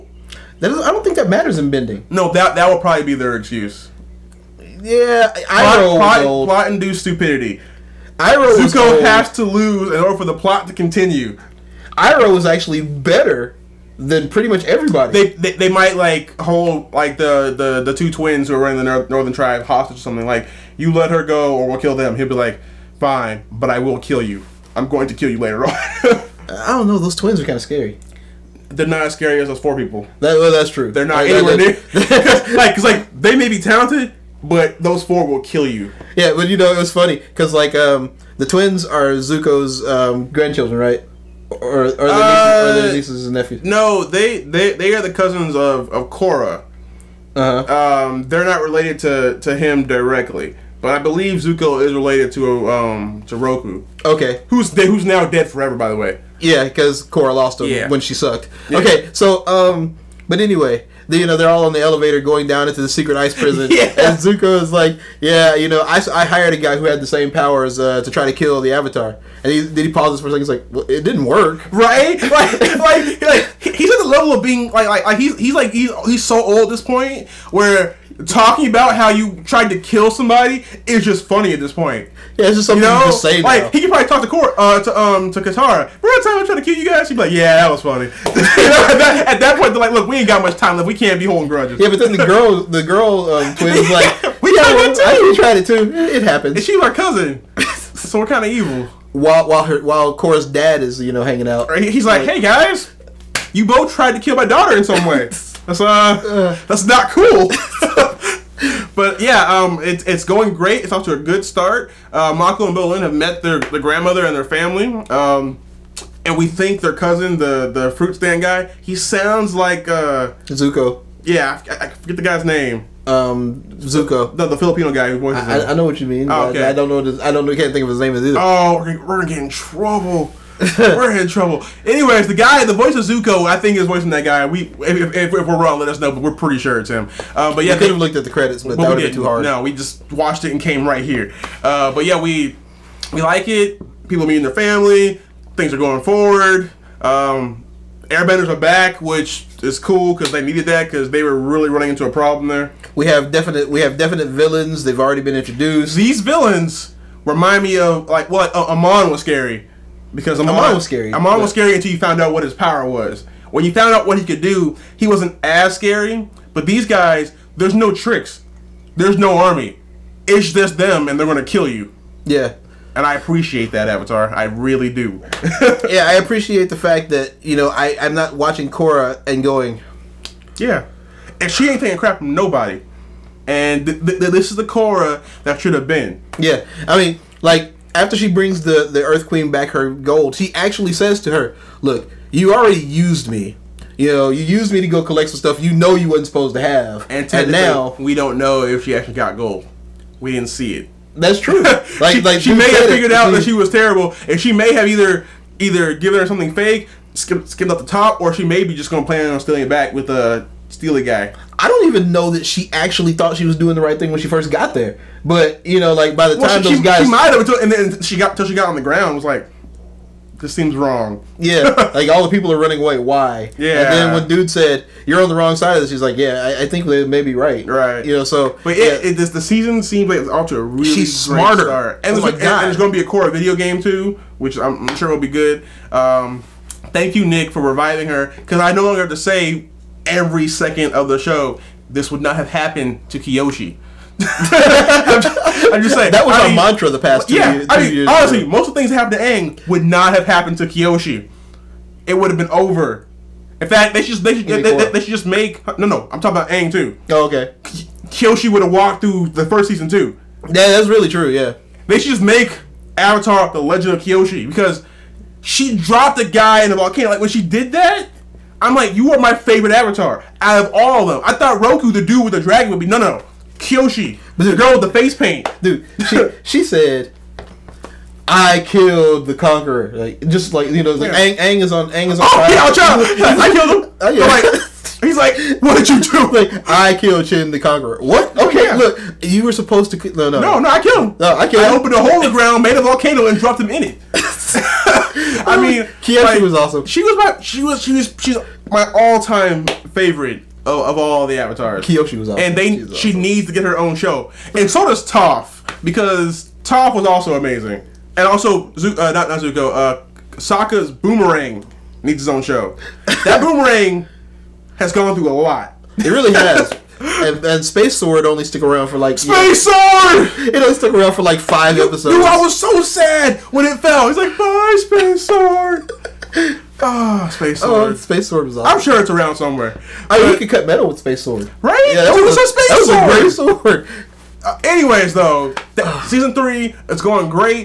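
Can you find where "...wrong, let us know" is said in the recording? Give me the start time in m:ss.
2:15.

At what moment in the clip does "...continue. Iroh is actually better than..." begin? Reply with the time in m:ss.
0:10.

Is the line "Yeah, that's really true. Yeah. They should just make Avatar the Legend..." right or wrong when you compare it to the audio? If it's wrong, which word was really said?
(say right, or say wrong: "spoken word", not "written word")
right.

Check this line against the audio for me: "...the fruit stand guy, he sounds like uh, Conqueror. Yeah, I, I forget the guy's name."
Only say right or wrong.
wrong.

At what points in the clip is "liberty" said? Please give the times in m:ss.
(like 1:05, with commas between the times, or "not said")
not said.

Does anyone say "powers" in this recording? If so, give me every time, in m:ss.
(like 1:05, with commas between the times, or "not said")
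1:07, 2:42.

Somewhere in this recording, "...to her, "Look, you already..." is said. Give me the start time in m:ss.
3:11.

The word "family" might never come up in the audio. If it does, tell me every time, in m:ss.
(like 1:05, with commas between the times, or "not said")
1:54, 2:24.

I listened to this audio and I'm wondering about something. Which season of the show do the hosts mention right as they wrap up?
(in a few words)
Season 3.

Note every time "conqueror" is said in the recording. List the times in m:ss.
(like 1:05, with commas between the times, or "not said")
4:39, 4:47.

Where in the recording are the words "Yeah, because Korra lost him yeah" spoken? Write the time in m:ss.
0:56.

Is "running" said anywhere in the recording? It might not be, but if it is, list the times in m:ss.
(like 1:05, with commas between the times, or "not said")
0:18, 2:31, 3:42.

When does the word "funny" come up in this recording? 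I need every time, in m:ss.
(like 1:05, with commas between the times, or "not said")
0:36, 1:21, 1:27.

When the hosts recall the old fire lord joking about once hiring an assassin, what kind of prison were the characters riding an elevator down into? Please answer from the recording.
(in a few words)
secret ice prison.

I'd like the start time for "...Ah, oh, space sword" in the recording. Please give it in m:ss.
5:26.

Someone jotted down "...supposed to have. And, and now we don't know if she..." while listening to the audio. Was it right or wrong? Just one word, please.
right.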